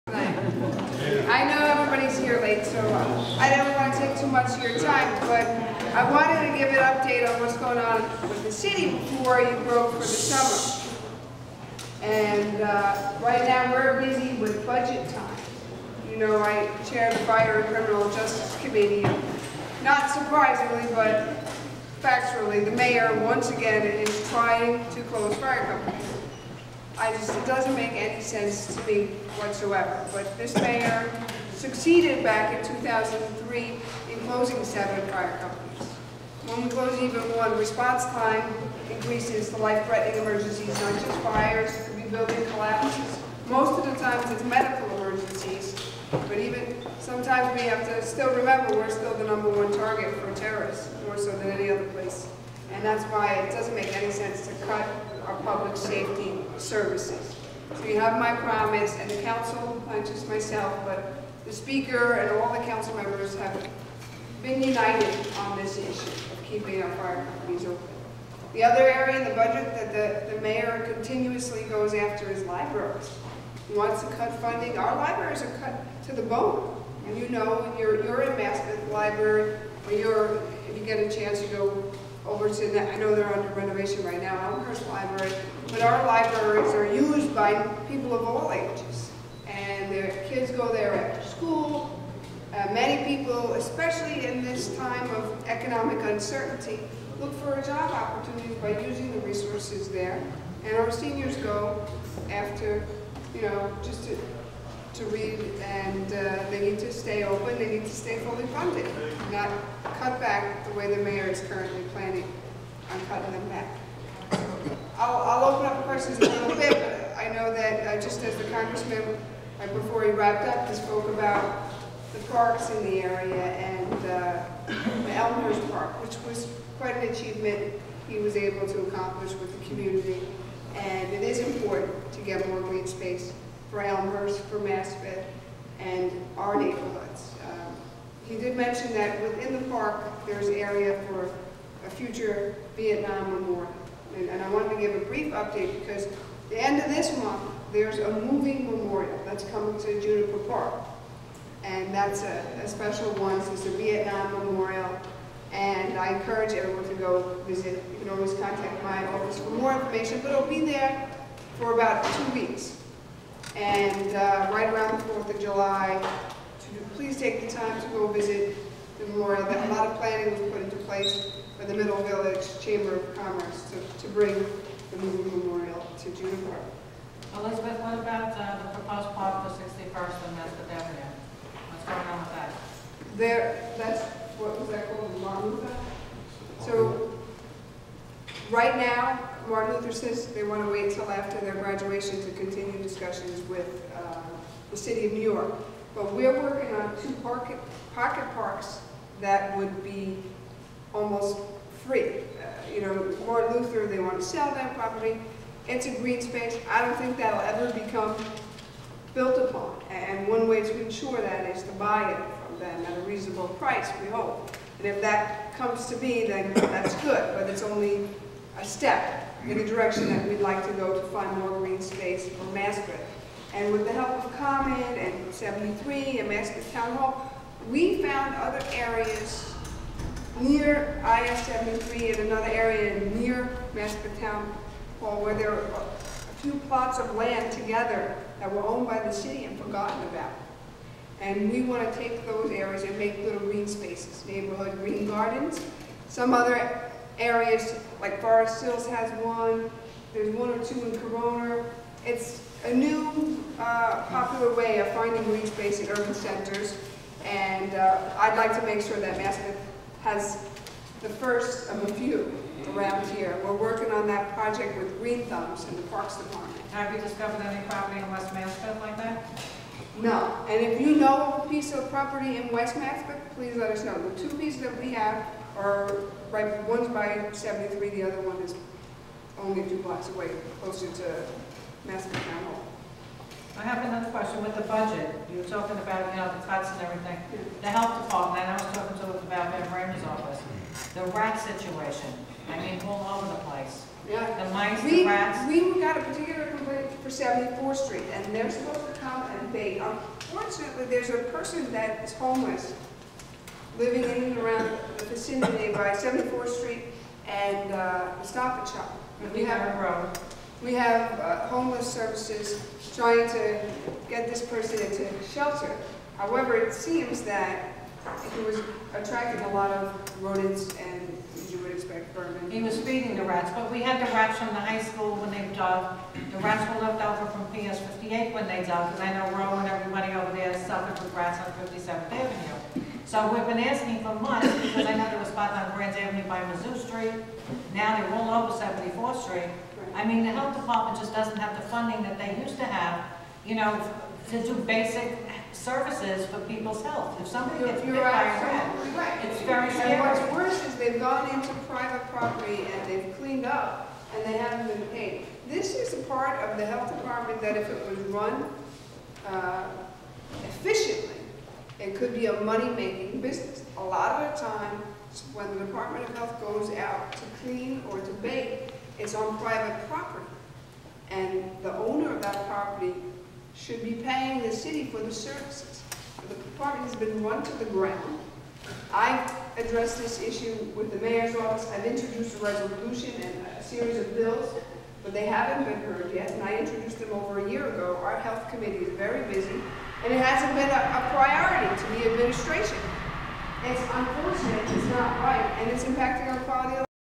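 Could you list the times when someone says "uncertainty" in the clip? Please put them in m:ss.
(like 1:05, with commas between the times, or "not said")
1:36.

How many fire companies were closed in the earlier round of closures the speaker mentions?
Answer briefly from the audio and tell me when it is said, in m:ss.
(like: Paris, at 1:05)
7, at 0:34.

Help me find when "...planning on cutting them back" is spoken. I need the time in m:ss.
1:51.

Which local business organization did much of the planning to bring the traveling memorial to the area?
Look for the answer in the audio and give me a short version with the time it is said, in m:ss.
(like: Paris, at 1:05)
Middle Village Chamber of Commerce, at 2:51.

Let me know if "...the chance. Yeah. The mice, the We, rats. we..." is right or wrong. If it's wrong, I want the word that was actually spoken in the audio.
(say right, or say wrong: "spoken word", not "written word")
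wrong: "place", not "chance".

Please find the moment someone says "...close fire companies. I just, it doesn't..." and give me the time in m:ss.
0:25.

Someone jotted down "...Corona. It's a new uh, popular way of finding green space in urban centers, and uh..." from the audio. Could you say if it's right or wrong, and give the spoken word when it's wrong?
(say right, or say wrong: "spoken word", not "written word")
right.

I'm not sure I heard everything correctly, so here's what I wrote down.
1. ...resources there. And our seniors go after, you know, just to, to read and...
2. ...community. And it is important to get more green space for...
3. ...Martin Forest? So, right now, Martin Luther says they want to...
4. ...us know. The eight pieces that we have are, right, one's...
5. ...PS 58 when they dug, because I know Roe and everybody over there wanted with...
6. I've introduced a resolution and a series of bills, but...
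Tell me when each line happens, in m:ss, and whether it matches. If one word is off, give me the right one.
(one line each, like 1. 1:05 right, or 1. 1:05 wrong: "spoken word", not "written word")
1. 1:39 right
2. 2:09 right
3. 3:05 wrong: "Luther", not "Forest"
4. 4:33 wrong: "two", not "eight"
5. 5:27 wrong: "suffered", not "wanted"
6. 6:21 right.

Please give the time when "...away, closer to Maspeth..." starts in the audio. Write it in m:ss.
4:40.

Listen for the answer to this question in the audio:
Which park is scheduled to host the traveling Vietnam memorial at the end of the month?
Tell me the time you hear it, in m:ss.
2:30.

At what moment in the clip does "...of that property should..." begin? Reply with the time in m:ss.
6:12.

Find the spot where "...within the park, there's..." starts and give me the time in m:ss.
2:19.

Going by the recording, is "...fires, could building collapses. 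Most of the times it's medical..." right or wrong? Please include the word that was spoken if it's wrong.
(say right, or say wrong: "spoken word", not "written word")
right.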